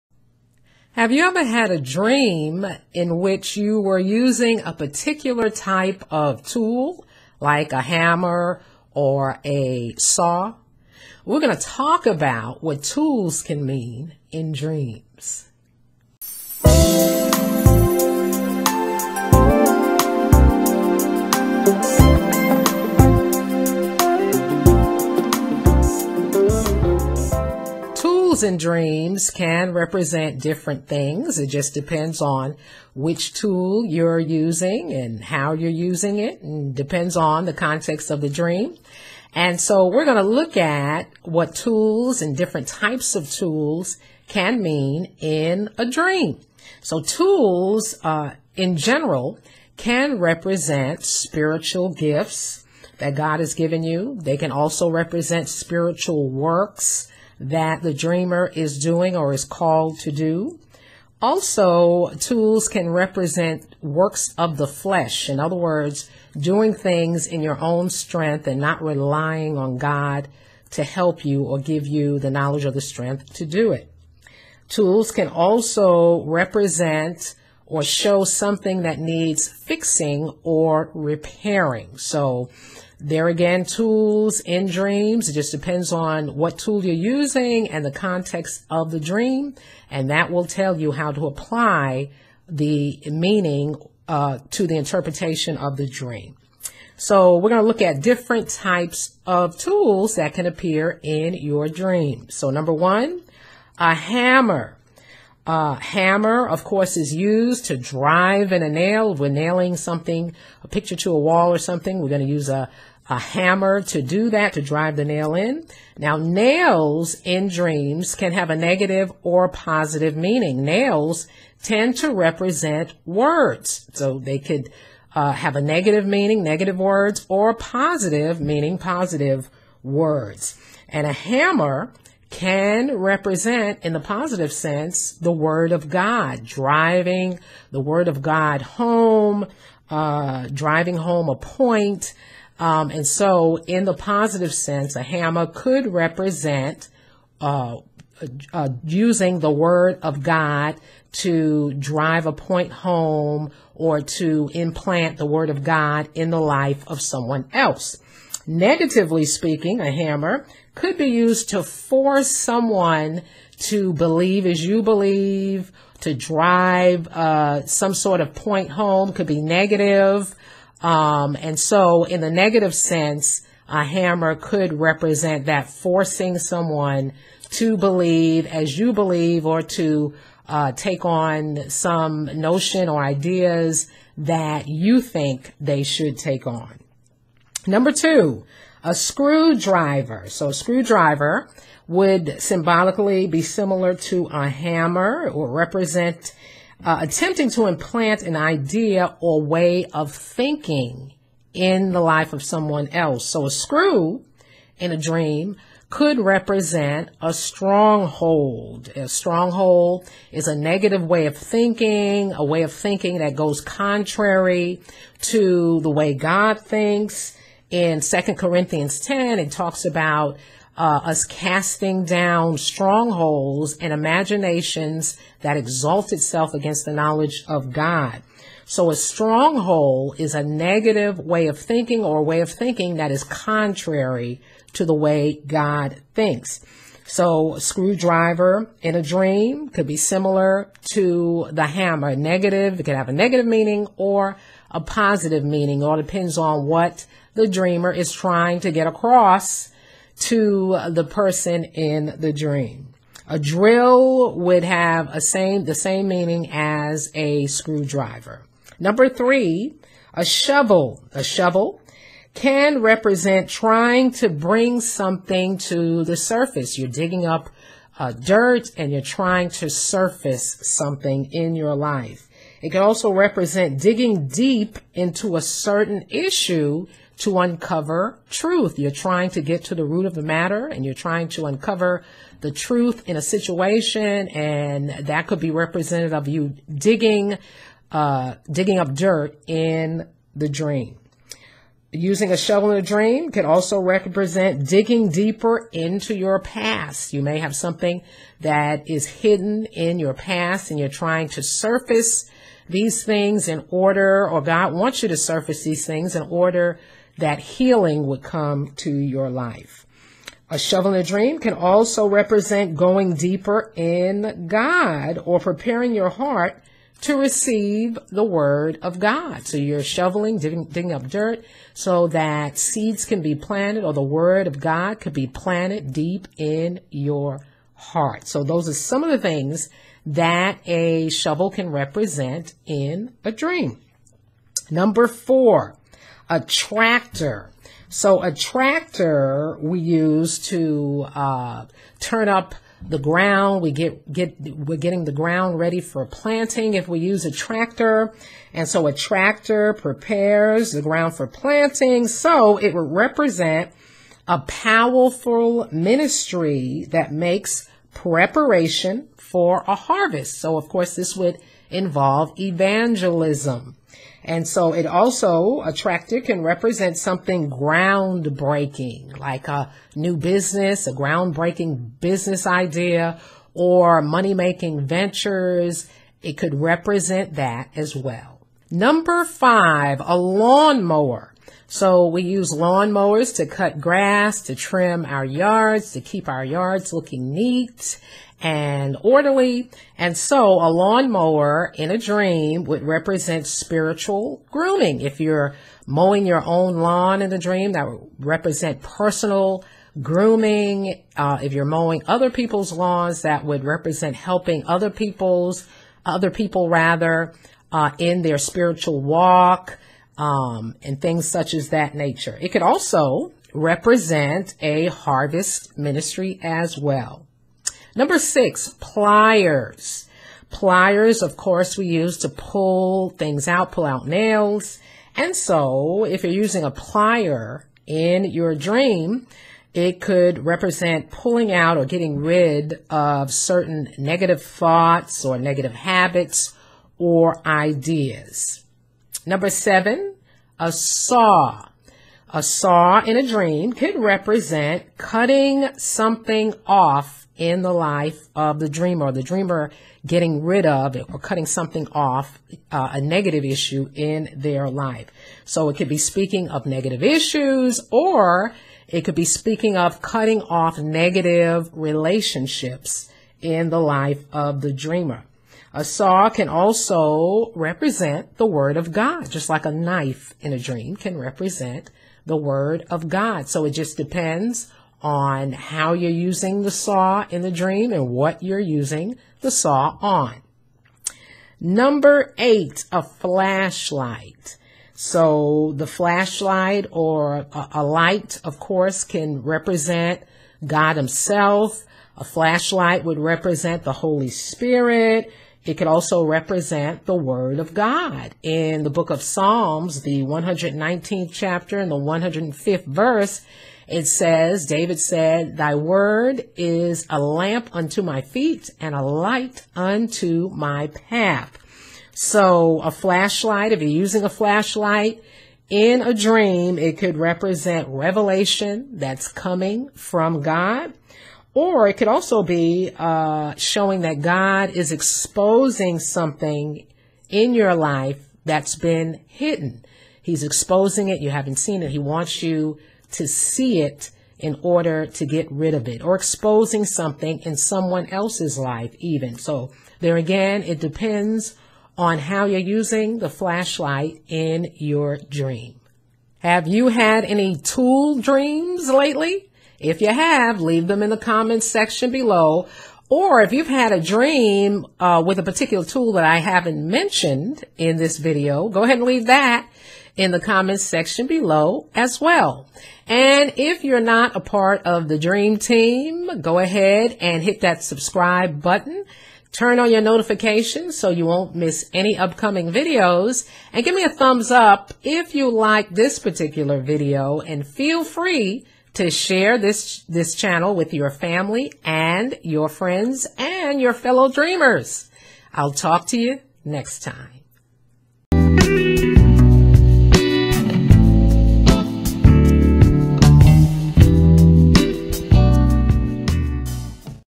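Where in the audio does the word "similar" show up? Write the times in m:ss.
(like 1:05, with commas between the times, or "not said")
3:13, 3:59.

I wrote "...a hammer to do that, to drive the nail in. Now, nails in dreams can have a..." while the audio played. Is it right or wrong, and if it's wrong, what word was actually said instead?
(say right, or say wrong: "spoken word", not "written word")
right.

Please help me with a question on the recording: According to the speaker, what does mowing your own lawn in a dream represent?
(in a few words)
Personal grooming.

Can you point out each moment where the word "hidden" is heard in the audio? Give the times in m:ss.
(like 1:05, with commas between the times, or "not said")
4:59, 8:49.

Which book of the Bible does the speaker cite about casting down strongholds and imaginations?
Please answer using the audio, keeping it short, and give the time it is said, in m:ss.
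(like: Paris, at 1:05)
Second Corinthians 10, at 3:38.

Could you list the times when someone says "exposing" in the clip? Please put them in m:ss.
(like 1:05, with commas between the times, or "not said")
8:44, 8:50, 8:56.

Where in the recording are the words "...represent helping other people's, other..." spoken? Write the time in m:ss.
6:43.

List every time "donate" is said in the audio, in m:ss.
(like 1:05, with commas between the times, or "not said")
not said.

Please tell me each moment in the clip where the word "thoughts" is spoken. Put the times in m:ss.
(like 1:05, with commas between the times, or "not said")
7:14.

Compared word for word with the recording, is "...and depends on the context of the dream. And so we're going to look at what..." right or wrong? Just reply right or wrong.
right.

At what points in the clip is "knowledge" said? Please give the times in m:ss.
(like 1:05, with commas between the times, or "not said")
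1:12, 3:46.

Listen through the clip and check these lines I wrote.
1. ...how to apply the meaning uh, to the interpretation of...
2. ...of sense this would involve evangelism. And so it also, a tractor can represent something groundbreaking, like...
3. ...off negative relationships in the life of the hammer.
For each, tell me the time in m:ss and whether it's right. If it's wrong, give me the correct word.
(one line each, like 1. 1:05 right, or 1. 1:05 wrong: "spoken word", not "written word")
1. 1:30 right
2. 6:00 wrong: "course", not "sense"
3. 7:40 wrong: "dreamer", not "hammer".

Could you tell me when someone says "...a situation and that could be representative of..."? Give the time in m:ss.
4:43.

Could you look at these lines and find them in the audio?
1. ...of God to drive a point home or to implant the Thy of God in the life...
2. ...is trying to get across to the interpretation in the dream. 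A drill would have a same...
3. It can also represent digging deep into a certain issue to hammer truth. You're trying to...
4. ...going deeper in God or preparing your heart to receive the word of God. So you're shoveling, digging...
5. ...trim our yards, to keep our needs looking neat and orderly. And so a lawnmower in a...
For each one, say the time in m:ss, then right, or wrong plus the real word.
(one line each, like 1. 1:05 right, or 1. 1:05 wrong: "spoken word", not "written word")
1. 2:30 wrong: "Word", not "Thy"
2. 4:07 wrong: "person", not "interpretation"
3. 4:32 wrong: "uncover", not "hammer"
4. 5:12 right
5. 6:24 wrong: "yards", not "needs".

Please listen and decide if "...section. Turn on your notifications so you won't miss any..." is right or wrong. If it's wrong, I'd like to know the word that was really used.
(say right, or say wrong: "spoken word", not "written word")
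wrong: "button", not "section".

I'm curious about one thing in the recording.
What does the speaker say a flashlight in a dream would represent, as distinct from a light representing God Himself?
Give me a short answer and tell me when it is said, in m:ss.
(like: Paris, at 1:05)
The Holy Spirit, at 8:13.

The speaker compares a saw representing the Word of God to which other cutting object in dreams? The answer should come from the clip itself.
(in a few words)
A knife.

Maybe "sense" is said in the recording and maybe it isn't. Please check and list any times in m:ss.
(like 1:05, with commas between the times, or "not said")
2:14, 2:24, 2:52.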